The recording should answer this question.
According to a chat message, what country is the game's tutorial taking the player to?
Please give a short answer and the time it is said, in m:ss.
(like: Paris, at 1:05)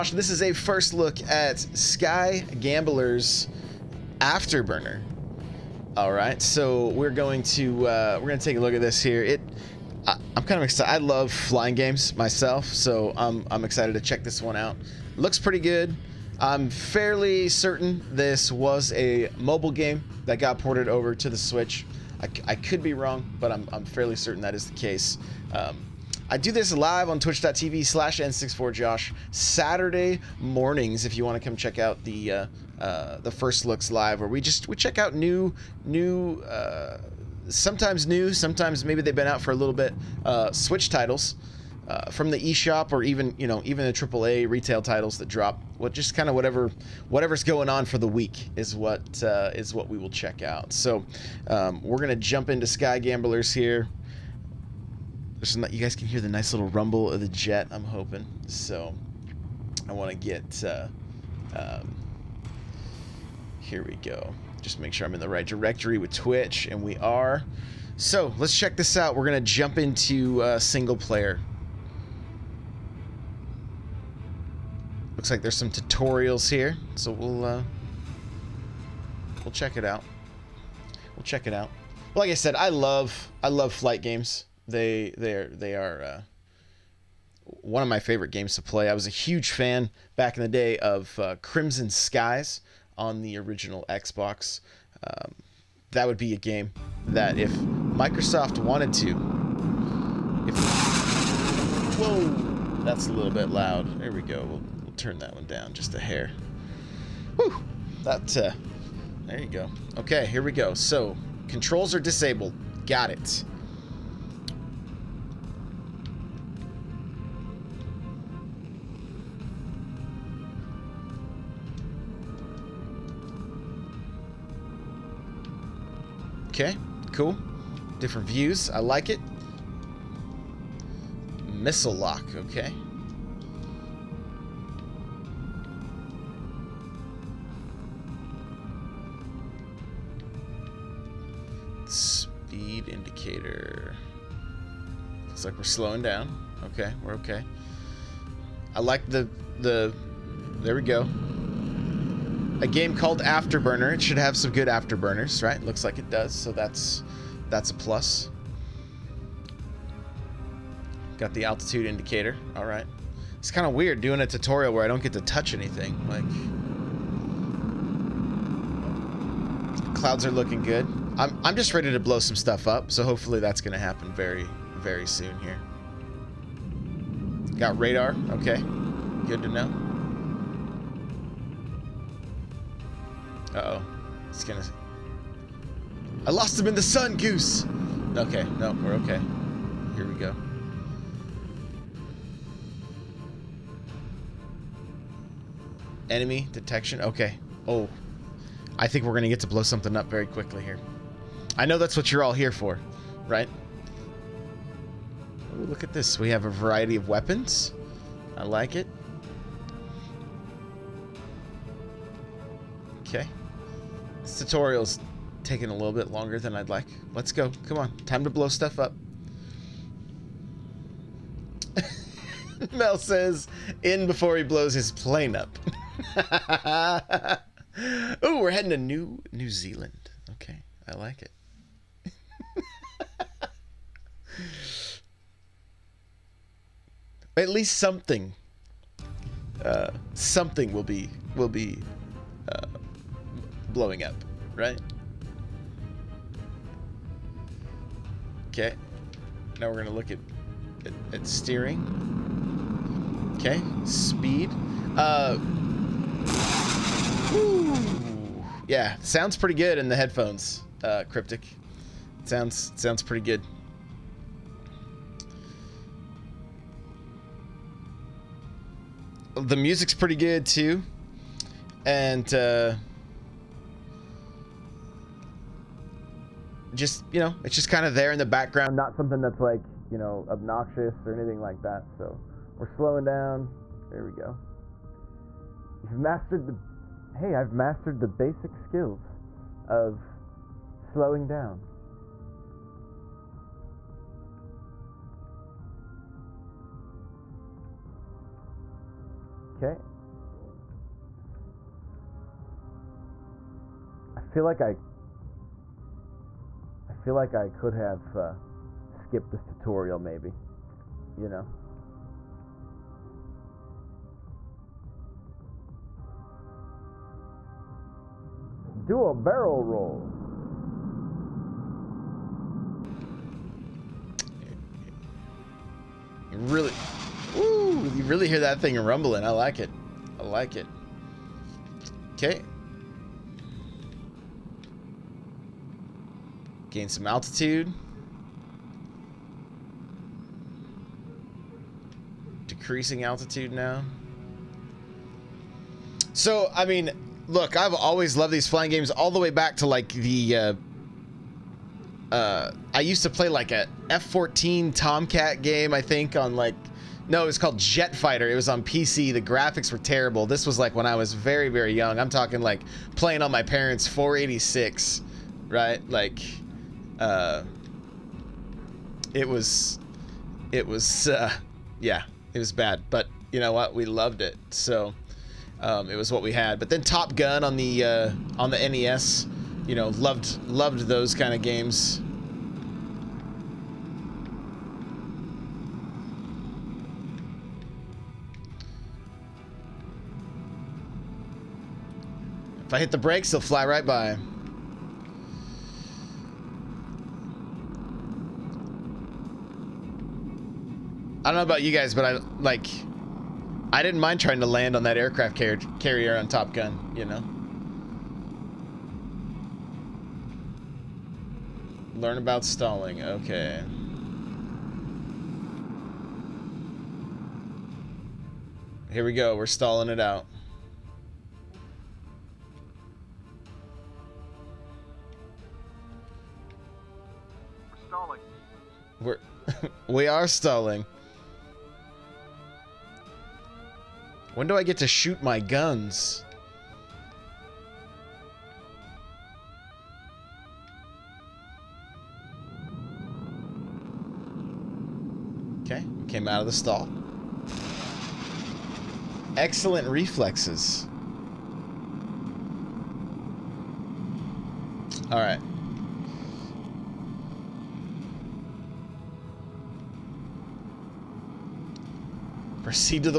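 New Zealand, at 3:49.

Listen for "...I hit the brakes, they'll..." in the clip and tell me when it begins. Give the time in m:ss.
6:32.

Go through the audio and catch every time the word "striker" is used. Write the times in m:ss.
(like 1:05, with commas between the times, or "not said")
not said.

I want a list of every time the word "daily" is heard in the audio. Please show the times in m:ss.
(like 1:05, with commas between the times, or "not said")
not said.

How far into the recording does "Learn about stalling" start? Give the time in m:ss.
6:52.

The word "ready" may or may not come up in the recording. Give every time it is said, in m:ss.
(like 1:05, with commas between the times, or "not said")
2:51.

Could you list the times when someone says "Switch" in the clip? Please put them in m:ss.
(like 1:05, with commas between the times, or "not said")
0:21, 0:40.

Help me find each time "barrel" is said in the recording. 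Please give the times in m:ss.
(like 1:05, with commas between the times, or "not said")
5:19.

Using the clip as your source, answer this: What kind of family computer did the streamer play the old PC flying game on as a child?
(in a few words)
486.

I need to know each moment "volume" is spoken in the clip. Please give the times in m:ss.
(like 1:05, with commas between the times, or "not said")
not said.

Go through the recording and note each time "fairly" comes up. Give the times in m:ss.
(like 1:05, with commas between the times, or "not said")
0:16, 0:23.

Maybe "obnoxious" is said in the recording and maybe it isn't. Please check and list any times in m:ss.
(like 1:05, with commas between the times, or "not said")
4:40.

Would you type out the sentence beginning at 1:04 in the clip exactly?
Just make sure I'm in the right directory with Twitch, and we are.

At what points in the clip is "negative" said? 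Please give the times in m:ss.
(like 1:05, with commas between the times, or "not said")
not said.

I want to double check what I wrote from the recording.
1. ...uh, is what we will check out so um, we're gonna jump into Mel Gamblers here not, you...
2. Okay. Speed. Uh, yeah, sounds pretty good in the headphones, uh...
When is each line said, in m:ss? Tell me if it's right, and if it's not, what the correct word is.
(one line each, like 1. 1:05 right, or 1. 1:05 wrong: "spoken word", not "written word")
1. 0:49 wrong: "Sky", not "Mel"
2. 4:13 right.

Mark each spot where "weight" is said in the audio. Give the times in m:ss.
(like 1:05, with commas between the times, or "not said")
not said.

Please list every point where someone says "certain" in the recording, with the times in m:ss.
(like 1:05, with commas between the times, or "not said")
0:17, 0:24.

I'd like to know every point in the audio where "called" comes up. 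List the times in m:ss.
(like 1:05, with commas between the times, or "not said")
2:32, 5:57.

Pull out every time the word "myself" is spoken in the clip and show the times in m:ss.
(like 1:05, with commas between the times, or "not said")
0:12.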